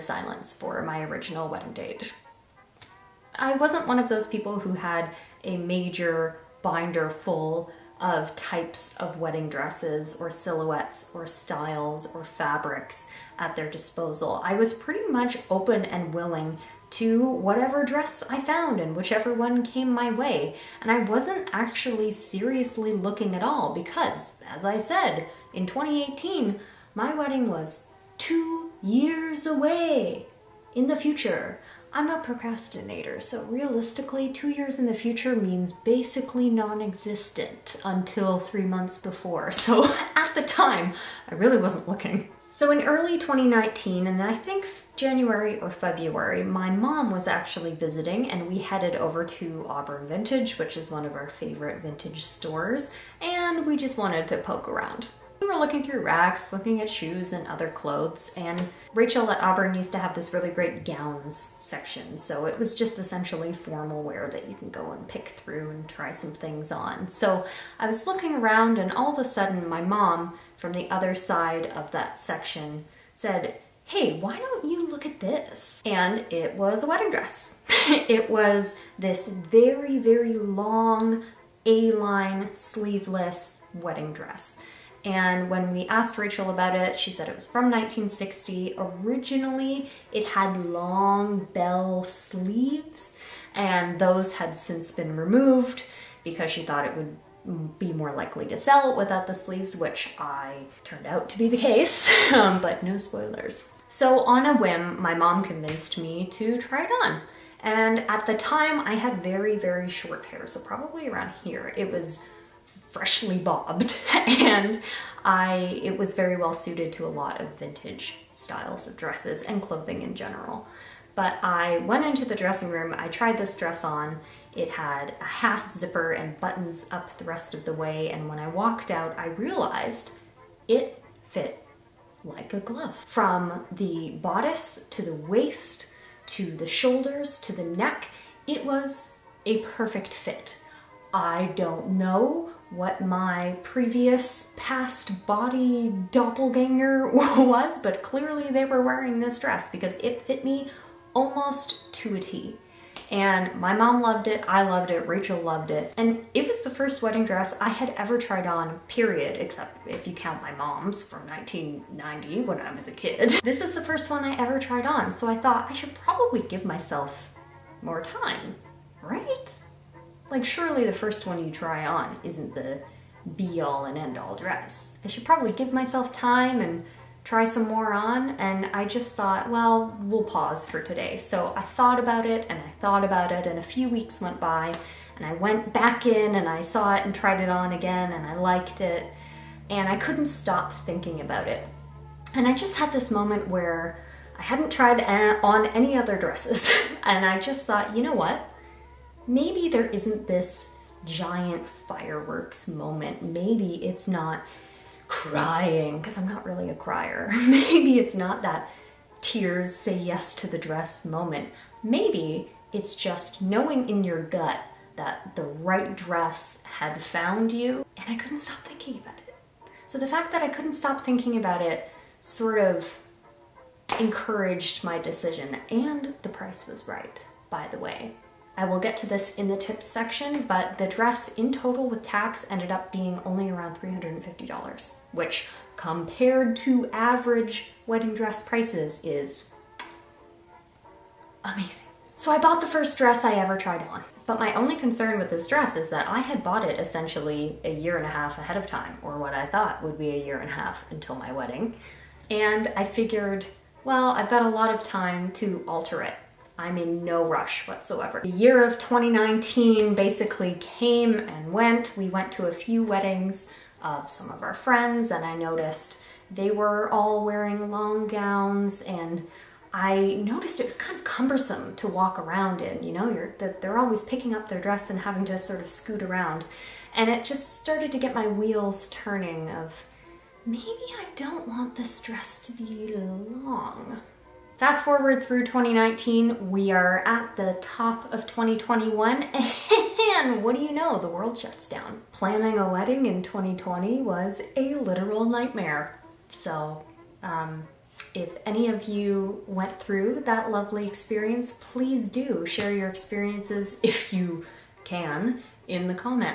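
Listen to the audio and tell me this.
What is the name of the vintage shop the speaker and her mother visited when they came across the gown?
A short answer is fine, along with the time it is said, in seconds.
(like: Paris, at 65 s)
Auburn Vintage, at 49 s.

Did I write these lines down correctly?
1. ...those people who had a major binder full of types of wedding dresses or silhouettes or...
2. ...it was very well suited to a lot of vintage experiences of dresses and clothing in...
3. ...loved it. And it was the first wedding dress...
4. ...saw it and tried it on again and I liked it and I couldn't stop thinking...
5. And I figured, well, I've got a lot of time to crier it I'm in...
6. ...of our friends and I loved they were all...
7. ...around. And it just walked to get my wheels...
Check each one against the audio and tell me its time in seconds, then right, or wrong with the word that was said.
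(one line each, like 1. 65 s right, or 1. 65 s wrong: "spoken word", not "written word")
1. 4 s right
2. 115 s wrong: "styles", not "experiences"
3. 155 s right
4. 186 s right
5. 252 s wrong: "alter", not "crier"
6. 264 s wrong: "noticed", not "loved"
7. 276 s wrong: "started", not "walked".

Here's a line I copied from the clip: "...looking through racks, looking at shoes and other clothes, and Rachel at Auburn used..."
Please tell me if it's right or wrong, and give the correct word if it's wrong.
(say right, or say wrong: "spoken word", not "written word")
right.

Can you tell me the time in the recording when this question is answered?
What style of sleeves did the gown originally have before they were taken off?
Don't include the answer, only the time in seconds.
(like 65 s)
91 s.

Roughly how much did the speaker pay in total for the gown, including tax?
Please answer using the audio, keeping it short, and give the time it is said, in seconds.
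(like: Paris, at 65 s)
$350, at 233 s.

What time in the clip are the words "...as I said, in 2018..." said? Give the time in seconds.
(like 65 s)
24 s.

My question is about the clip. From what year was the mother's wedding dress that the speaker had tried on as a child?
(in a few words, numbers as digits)
1990.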